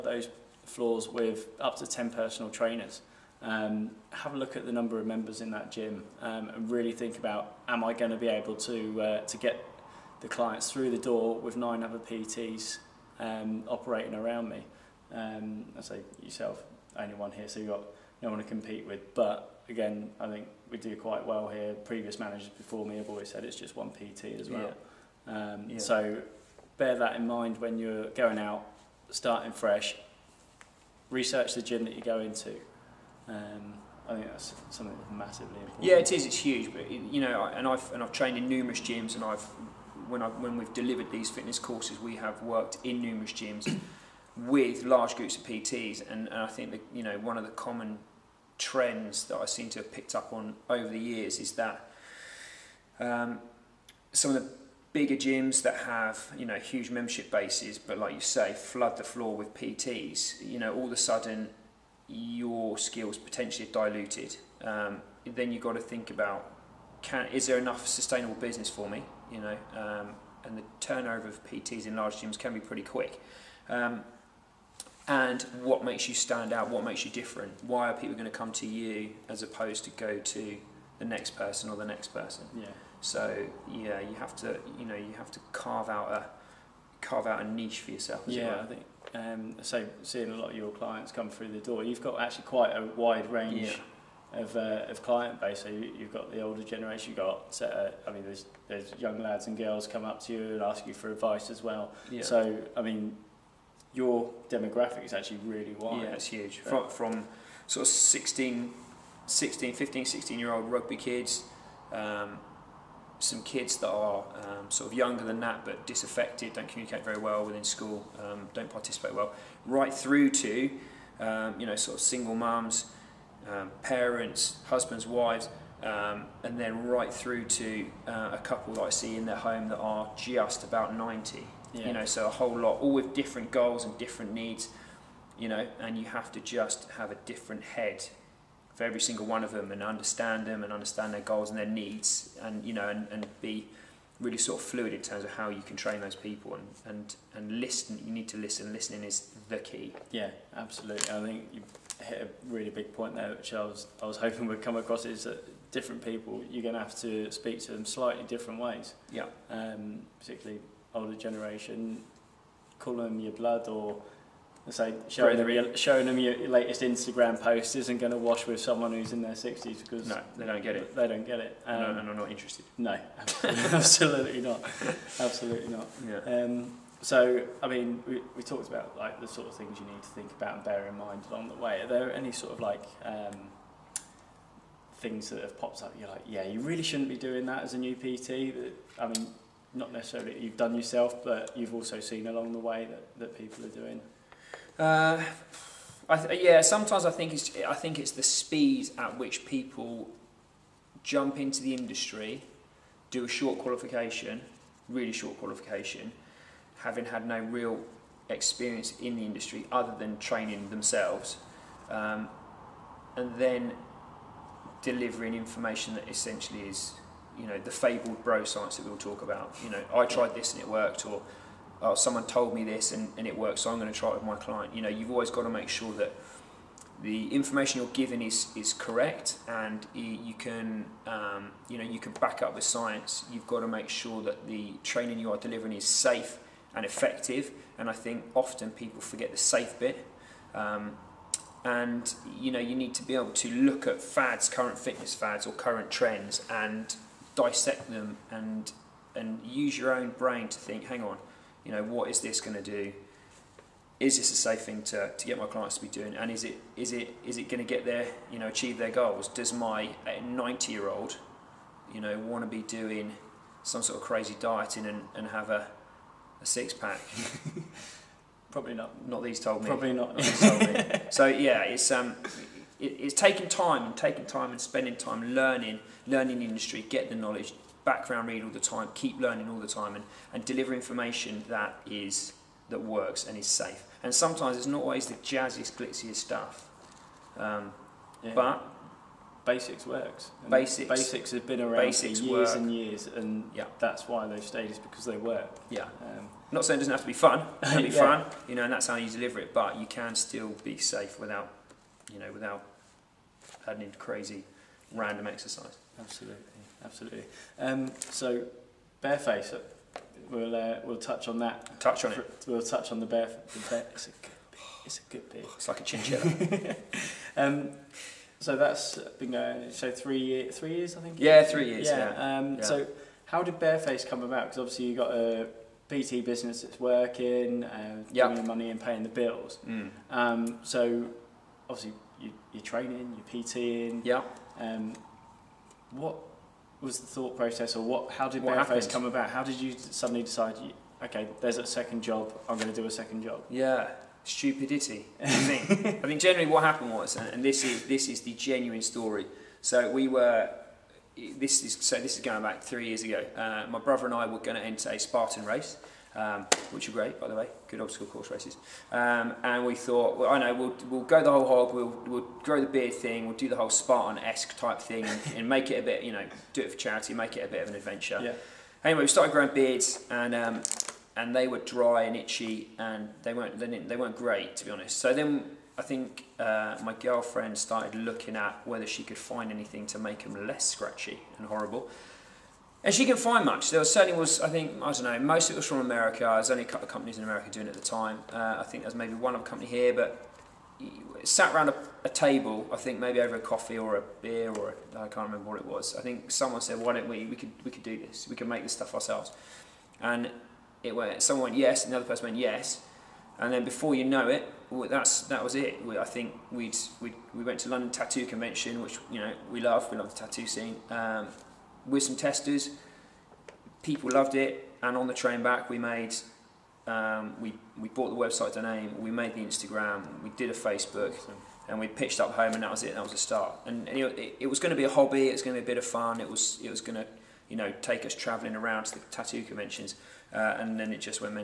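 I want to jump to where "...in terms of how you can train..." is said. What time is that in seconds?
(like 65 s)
144 s.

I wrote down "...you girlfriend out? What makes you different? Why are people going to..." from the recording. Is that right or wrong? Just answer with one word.
wrong.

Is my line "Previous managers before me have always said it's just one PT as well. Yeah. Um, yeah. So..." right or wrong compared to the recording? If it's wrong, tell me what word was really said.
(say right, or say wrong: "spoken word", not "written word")
right.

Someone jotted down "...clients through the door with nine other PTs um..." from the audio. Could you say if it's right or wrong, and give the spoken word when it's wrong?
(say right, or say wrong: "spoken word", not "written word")
right.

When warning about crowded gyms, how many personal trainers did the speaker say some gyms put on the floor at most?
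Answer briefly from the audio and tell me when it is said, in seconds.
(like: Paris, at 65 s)
10, at 1 s.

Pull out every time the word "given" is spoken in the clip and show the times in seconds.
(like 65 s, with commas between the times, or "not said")
227 s.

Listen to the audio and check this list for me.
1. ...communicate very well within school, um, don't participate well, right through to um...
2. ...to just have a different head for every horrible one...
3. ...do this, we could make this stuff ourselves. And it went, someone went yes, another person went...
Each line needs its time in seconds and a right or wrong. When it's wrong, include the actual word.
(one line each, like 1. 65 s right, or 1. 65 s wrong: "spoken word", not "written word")
1. 116 s right
2. 136 s wrong: "single", not "horrible"
3. 397 s right.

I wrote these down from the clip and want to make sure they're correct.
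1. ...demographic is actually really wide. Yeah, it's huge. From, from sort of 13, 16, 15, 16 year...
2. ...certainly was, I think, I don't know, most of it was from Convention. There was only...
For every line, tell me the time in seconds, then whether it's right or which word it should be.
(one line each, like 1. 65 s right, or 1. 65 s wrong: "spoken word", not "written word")
1. 104 s wrong: "16", not "13"
2. 383 s wrong: "America", not "Convention".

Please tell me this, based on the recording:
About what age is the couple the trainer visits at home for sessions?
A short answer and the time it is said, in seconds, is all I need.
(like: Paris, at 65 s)
90, at 130 s.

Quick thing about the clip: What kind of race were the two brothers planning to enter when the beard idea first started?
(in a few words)
Spartan race.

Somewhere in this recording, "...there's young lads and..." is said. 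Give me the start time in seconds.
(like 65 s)
98 s.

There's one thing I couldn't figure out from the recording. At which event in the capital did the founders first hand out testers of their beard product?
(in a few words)
London Tattoo Convention.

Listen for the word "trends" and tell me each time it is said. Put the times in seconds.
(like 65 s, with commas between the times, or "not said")
48 s, 245 s.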